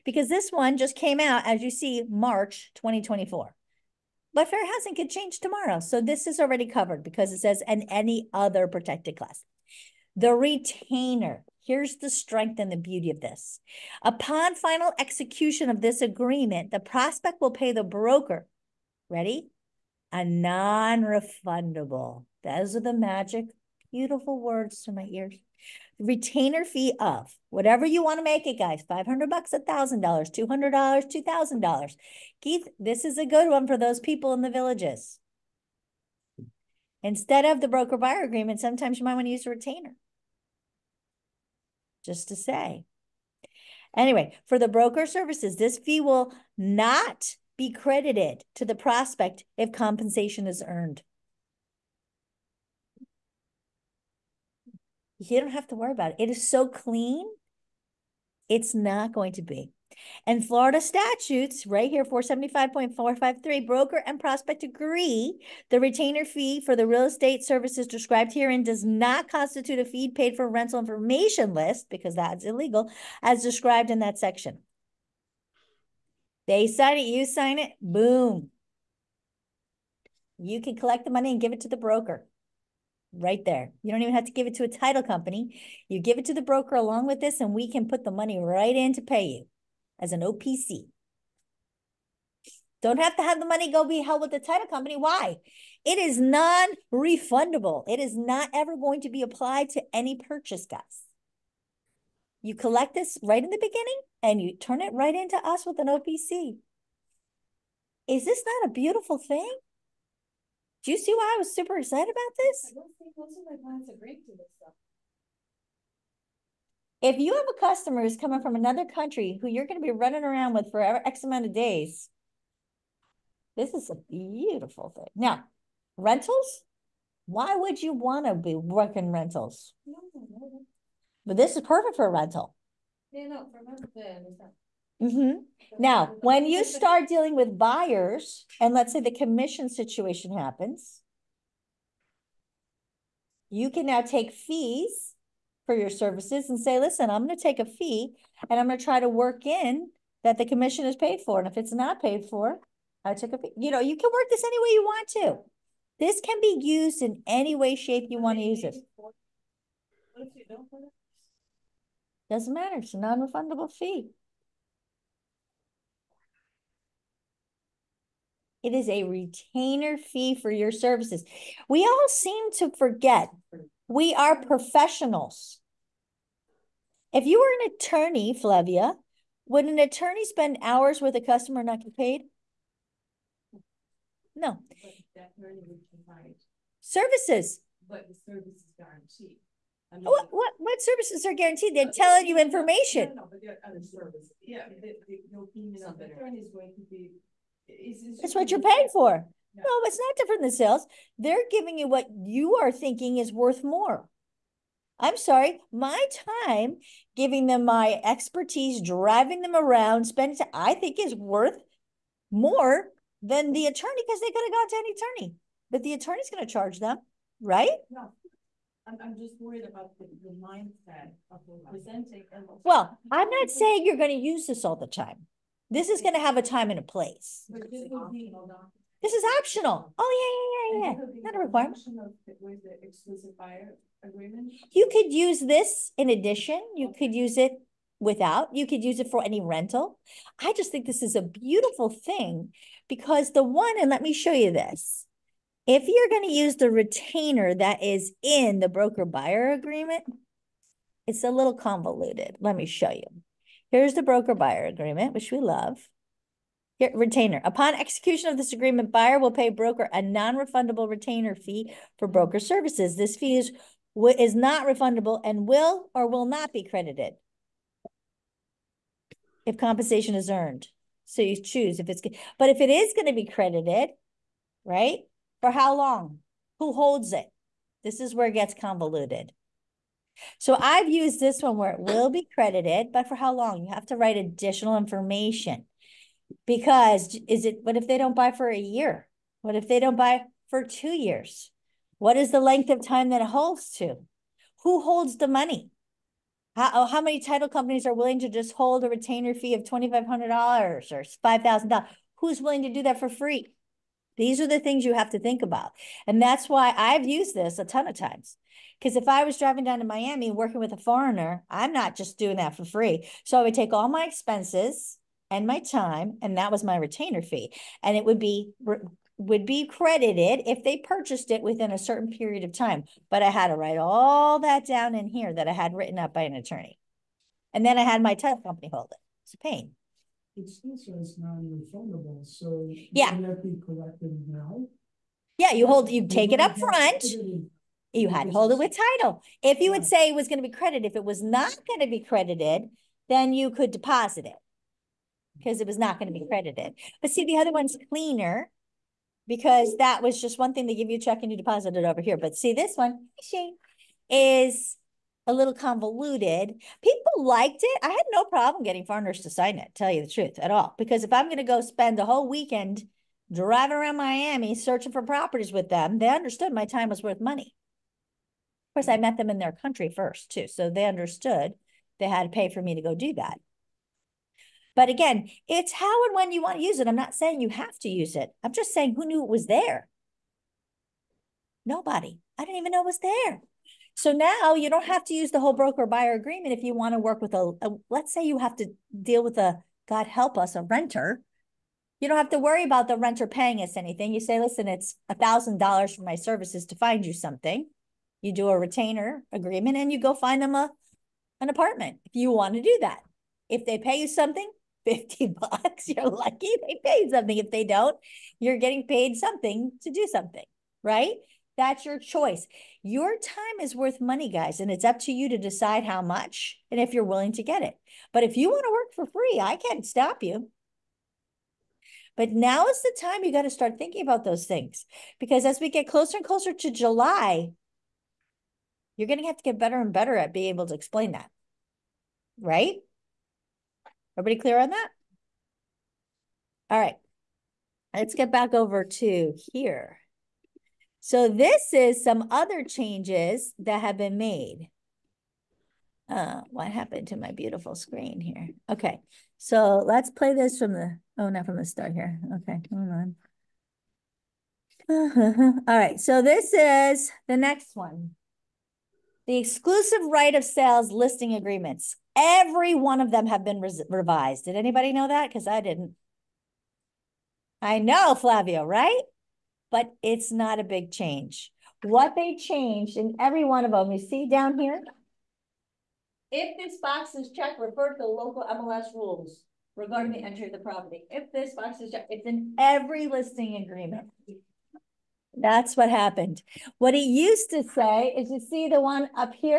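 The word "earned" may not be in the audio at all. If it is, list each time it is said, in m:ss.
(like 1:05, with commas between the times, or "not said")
0:50, 4:30.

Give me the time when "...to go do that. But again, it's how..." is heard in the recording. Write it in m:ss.
6:12.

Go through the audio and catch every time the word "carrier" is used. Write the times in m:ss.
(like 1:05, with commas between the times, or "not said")
not said.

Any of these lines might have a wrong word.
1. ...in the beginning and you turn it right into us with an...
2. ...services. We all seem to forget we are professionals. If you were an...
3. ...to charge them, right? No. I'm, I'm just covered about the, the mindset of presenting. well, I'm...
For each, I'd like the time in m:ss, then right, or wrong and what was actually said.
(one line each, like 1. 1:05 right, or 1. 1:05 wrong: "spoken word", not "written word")
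1. 1:43 right
2. 2:50 right
3. 3:36 wrong: "worried", not "covered".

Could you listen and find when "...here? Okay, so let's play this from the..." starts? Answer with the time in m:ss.
7:28.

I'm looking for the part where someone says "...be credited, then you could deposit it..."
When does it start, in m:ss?
5:41.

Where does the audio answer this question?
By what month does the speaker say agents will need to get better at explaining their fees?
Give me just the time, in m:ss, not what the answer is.
7:06.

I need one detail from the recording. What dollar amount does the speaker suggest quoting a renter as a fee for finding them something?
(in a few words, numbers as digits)
$1,000.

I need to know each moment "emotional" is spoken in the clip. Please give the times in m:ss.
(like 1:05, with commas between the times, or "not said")
not said.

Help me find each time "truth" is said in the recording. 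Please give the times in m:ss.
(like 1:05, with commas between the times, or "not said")
6:00.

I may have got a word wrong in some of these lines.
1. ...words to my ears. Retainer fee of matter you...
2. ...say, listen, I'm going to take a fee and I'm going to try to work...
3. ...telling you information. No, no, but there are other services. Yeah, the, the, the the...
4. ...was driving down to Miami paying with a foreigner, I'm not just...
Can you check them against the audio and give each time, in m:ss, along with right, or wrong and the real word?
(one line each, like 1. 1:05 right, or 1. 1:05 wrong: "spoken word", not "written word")
1. 0:24 wrong: "whatever", not "matter"
2. 2:26 right
3. 3:11 right
4. 5:09 wrong: "working", not "paying".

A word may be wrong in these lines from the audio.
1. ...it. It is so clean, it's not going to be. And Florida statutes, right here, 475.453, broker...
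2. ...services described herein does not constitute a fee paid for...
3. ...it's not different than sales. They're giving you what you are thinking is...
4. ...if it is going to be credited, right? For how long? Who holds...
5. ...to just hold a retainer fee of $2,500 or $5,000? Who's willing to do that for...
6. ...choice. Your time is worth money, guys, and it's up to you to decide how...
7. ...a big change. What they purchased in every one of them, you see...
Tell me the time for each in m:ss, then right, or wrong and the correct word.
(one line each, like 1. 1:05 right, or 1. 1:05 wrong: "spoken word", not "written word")
1. 0:56 right
2. 1:07 right
3. 3:19 right
4. 4:32 right
5. 4:58 right
6. 6:51 right
7. 7:50 wrong: "changed", not "purchased".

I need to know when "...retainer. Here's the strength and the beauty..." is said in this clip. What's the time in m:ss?
0:10.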